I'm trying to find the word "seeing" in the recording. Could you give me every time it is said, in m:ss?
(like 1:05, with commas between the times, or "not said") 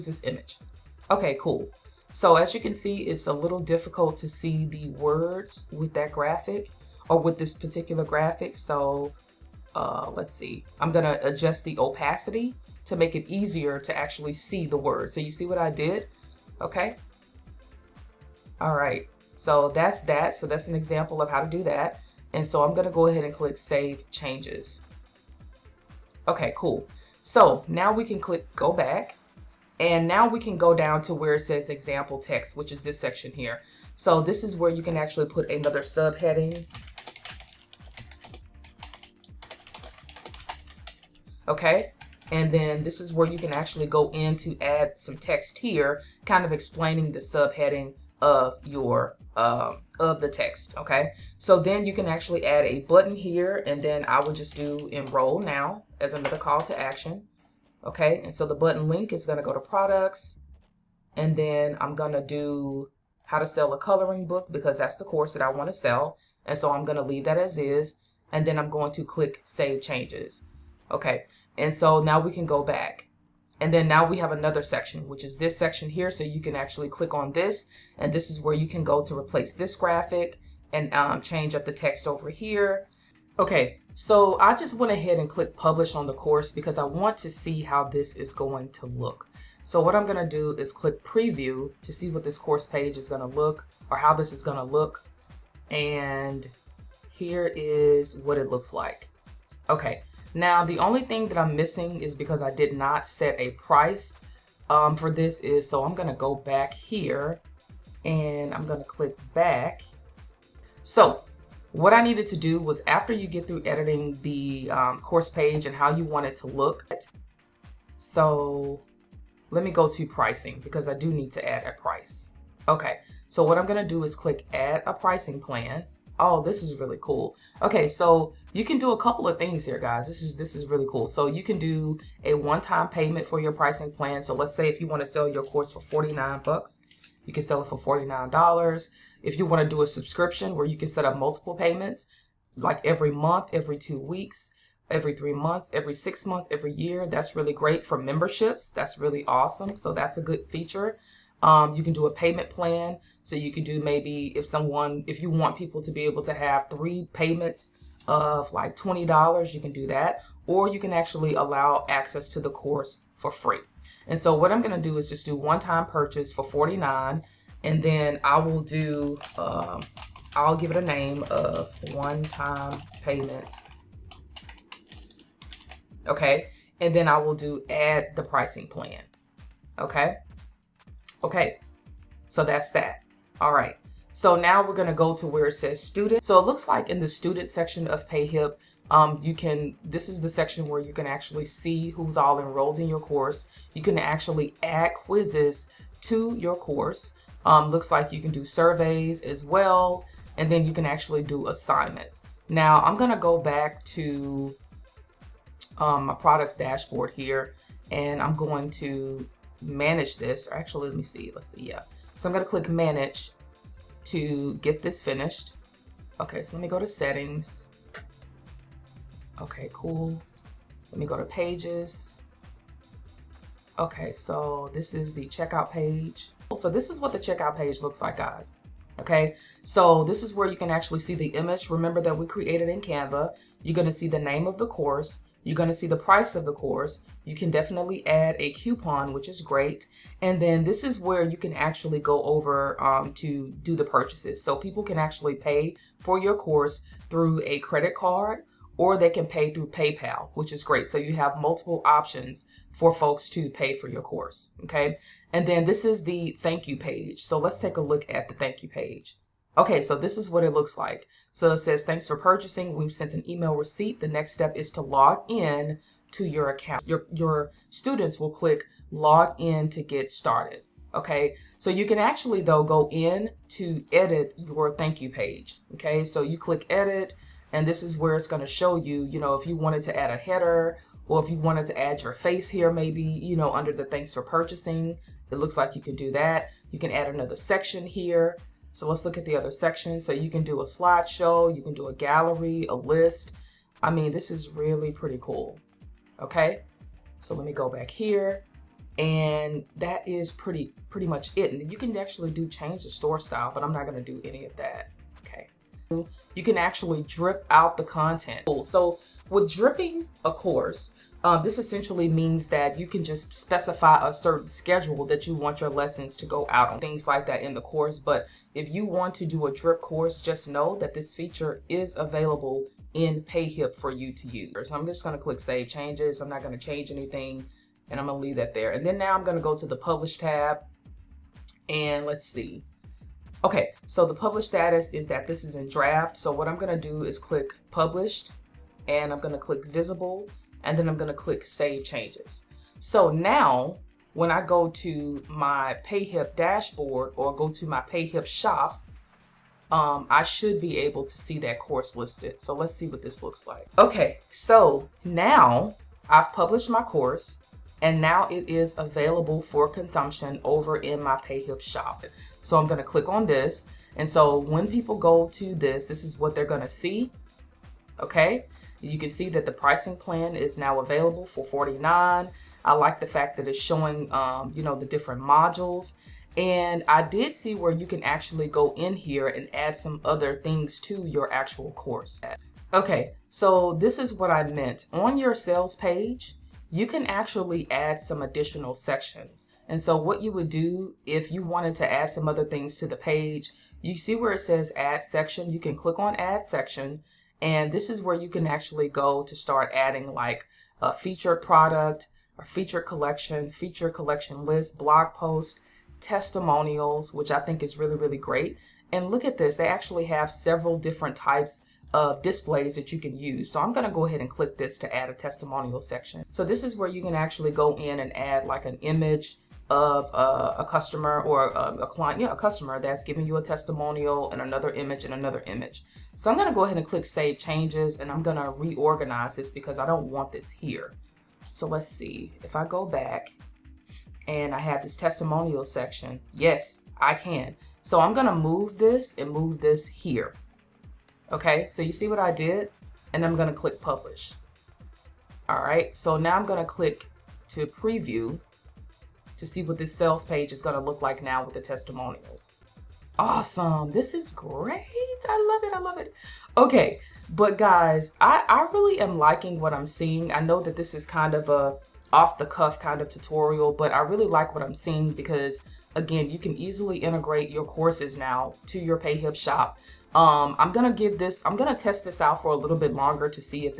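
7:39, 7:44.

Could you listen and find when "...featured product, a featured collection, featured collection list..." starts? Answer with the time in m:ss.
6:40.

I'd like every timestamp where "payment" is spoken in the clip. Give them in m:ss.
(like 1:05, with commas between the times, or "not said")
2:12, 2:21, 2:32, 2:37, 2:53.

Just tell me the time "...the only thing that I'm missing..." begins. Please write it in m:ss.
1:40.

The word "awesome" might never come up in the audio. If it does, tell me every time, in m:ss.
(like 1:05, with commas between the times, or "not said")
2:29, 7:33.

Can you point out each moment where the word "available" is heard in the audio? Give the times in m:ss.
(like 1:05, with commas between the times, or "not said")
5:21, 5:58, 6:10.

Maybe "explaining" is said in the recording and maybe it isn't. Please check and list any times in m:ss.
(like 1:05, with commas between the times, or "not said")
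0:46.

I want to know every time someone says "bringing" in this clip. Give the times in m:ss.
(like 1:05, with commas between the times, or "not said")
not said.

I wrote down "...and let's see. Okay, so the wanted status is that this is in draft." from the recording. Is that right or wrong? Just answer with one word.
wrong.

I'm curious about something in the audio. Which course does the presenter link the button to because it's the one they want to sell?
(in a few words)
How to sell a coloring book.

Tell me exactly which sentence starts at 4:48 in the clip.
So let's look at the other section.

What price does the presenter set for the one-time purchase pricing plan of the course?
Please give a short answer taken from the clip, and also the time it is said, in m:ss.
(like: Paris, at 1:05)
$49, at 2:45.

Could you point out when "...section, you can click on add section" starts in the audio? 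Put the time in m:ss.
6:35.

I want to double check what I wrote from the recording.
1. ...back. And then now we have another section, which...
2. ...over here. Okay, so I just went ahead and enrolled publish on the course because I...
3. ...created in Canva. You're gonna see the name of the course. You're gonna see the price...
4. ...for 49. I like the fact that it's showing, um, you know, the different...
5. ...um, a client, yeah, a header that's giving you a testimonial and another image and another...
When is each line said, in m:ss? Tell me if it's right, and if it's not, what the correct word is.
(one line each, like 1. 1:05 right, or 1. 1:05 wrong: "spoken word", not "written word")
1. 1:12 right
2. 1:22 wrong: "clicked", not "enrolled"
3. 3:52 right
4. 6:11 right
5. 7:01 wrong: "customer", not "header".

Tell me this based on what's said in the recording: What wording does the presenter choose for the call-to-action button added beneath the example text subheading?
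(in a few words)
Enroll now.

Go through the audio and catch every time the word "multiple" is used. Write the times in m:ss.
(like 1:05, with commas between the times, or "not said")
2:21, 4:11.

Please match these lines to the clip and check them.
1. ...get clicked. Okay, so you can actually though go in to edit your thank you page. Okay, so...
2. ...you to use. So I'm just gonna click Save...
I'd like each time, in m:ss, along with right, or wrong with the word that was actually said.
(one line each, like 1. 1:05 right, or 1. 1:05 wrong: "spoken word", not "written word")
1. 4:29 wrong: "started", not "clicked"
2. 5:23 right.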